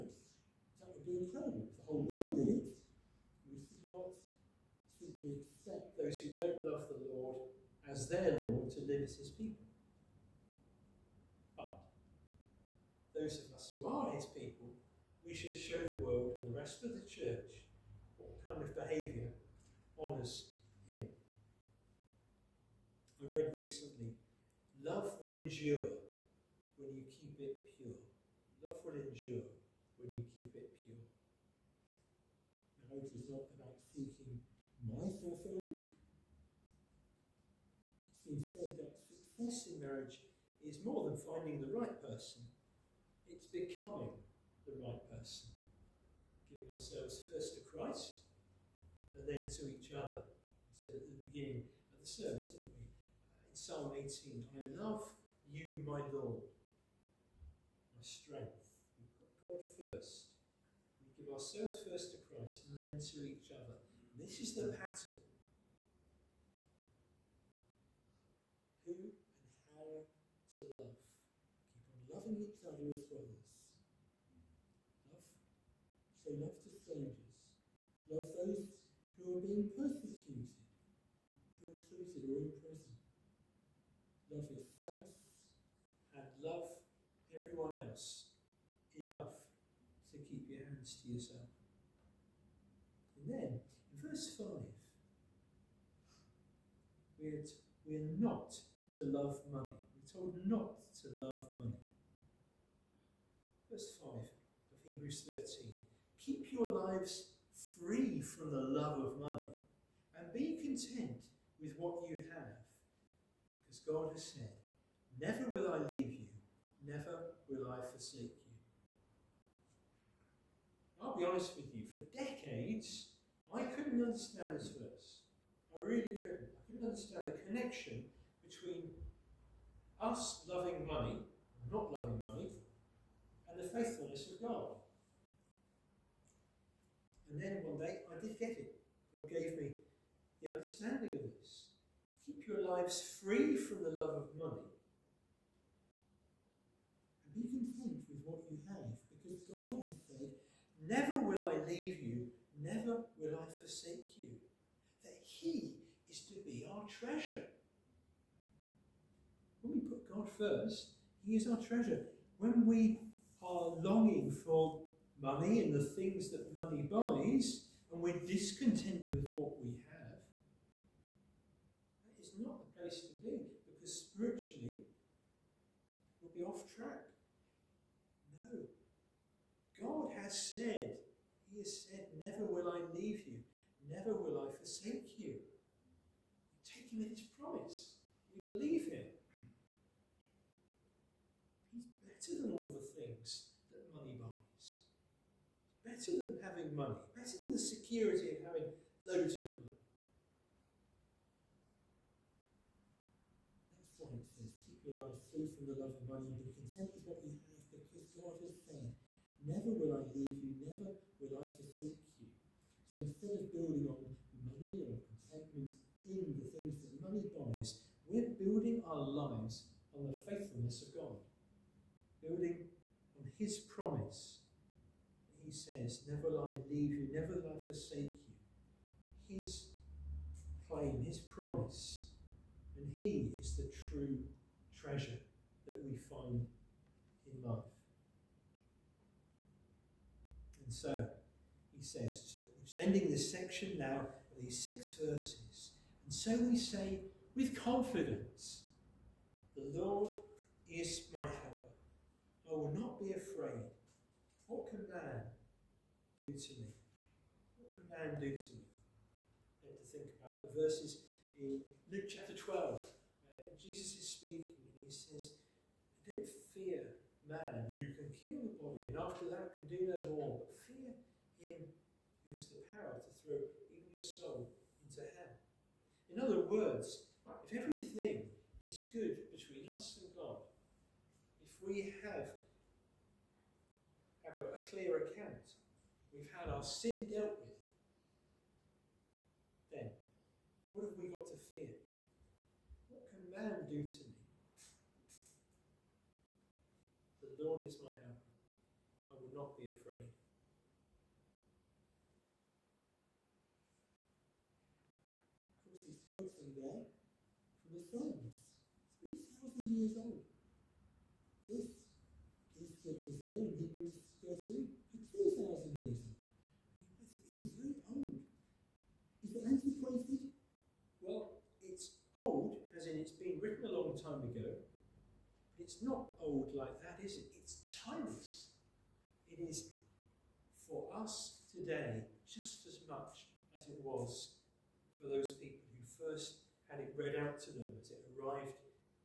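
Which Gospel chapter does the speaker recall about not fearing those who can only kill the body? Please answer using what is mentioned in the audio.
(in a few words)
Luke 12.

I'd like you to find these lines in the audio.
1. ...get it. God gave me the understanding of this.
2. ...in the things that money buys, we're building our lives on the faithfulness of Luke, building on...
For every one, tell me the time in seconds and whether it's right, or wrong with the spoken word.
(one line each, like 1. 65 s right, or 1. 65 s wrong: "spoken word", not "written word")
1. 138 s right
2. 216 s wrong: "God", not "Luke".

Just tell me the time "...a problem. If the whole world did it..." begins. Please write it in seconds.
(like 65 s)
1 s.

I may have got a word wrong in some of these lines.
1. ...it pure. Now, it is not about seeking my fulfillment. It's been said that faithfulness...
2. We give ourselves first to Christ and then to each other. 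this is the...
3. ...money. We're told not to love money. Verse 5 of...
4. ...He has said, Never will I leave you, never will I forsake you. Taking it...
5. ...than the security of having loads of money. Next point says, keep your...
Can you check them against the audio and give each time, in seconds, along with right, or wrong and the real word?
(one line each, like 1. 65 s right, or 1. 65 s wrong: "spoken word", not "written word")
1. 30 s wrong: "success", not "faithfulness"
2. 61 s right
3. 99 s right
4. 181 s right
5. 197 s right.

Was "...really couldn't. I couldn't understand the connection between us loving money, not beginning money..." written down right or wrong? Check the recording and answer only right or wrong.
wrong.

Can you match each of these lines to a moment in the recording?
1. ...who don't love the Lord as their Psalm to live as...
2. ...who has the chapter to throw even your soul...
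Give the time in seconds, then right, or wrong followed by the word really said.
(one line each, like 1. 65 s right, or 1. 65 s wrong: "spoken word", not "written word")
1. 6 s wrong: "Lord", not "Psalm"
2. 272 s wrong: "power", not "chapter".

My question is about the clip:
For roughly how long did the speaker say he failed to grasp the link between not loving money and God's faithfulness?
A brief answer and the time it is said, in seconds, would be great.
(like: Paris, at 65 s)
decades, at 122 s.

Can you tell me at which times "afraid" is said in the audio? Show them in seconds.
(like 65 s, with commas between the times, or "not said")
253 s, 299 s.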